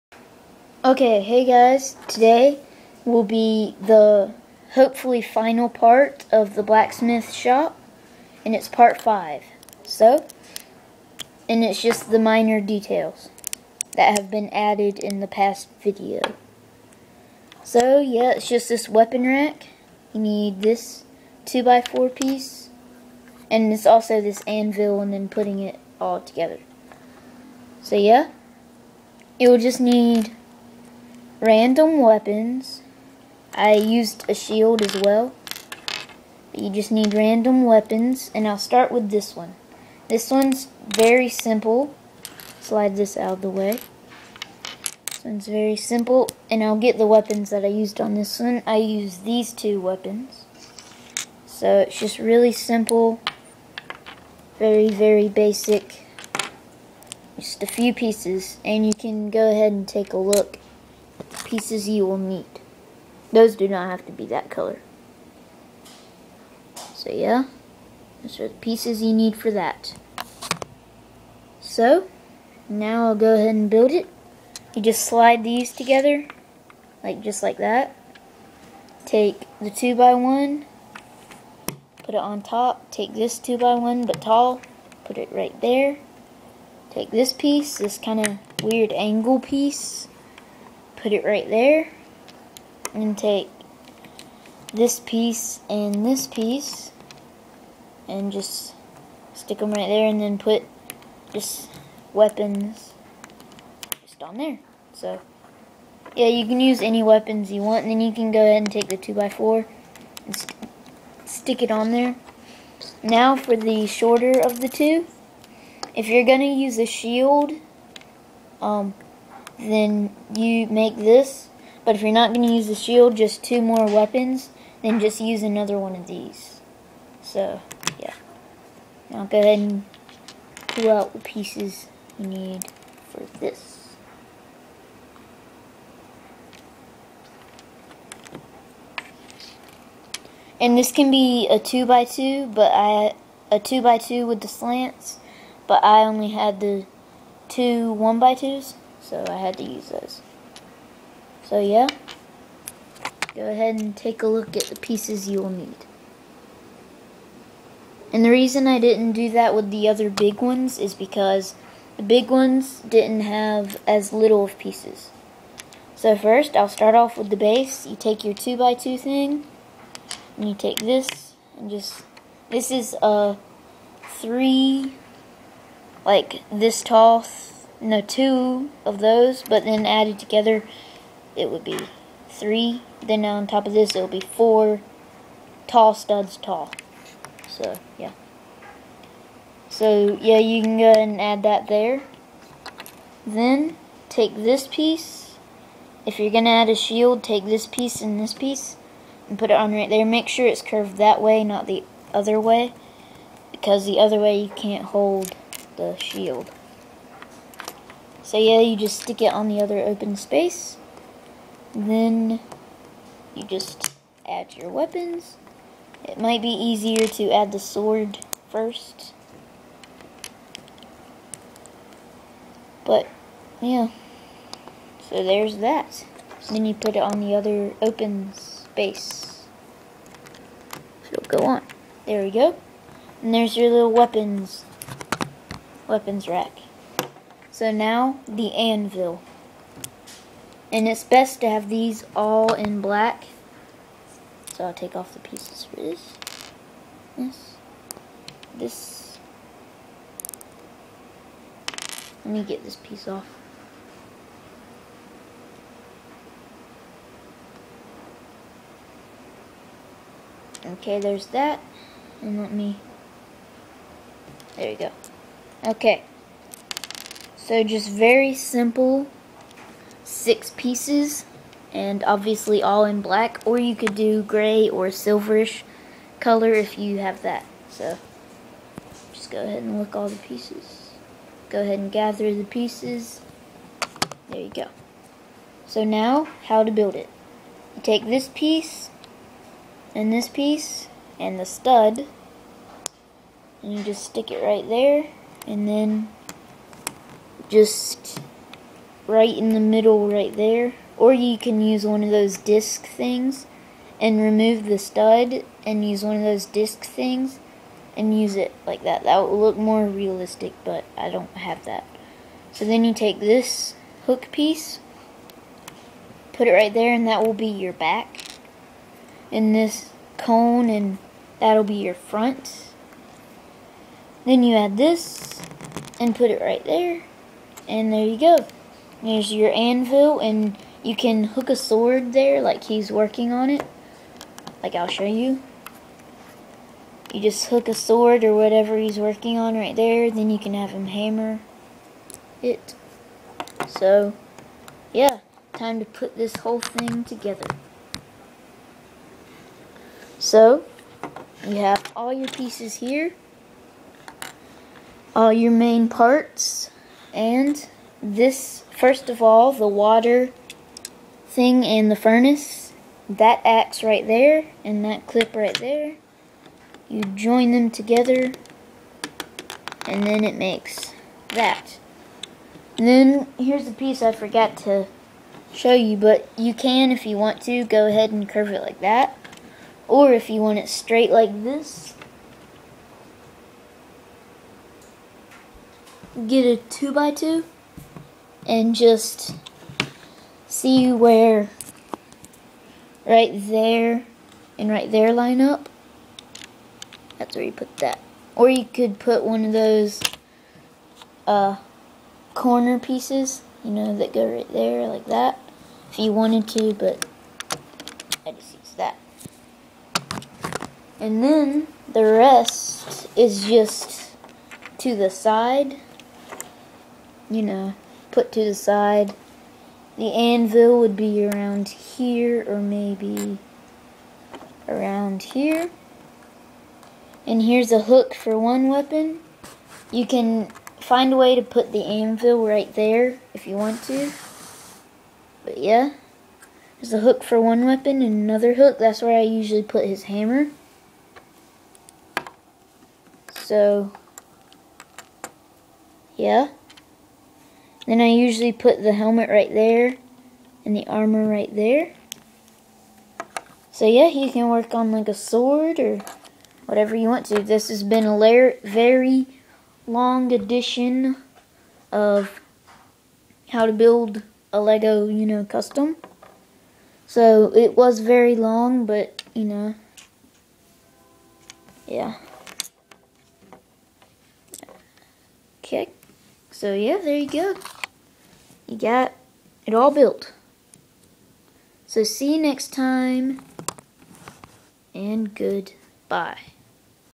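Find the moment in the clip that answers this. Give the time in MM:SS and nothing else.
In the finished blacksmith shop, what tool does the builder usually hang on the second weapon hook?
07:19.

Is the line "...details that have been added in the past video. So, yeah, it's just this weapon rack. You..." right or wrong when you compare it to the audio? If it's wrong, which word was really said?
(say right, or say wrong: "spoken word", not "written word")
right.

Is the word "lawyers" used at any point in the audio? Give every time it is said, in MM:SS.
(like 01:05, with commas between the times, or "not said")
not said.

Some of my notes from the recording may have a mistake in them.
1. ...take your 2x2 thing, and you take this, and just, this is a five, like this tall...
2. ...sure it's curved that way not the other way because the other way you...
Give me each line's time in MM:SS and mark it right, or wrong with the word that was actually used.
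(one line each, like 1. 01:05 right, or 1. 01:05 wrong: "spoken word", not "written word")
1. 02:47 wrong: "three", not "five"
2. 03:20 right.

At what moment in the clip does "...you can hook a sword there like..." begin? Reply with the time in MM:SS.
05:30.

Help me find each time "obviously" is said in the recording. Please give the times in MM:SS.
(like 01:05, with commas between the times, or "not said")
04:32.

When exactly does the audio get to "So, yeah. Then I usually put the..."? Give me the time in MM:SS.
07:23.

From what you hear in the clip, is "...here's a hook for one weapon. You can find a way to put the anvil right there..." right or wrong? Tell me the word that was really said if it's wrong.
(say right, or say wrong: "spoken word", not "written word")
right.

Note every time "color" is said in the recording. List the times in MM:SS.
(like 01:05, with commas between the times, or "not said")
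01:04, 04:36.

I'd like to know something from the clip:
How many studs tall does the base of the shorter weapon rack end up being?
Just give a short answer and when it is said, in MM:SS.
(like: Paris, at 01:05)
4, at 03:04.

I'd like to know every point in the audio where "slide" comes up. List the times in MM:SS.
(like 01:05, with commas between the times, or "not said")
00:42, 01:15.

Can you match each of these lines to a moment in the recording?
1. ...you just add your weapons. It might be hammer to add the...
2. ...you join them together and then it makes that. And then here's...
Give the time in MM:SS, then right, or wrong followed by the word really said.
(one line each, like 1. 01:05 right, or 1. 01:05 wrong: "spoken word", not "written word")
1. 03:33 wrong: "easier", not "hammer"
2. 06:06 right.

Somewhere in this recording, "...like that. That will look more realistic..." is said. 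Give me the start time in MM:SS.
05:08.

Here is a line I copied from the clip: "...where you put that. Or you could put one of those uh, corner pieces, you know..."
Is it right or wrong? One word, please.
right.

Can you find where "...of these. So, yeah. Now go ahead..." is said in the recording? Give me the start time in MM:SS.
02:05.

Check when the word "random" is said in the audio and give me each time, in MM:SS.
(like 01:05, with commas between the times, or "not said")
00:31, 00:37.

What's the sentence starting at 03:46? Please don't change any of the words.
Then you put it on the other open space.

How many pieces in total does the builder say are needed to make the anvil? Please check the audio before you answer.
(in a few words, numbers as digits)
6.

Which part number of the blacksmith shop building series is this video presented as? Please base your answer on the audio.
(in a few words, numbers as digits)
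Part 5.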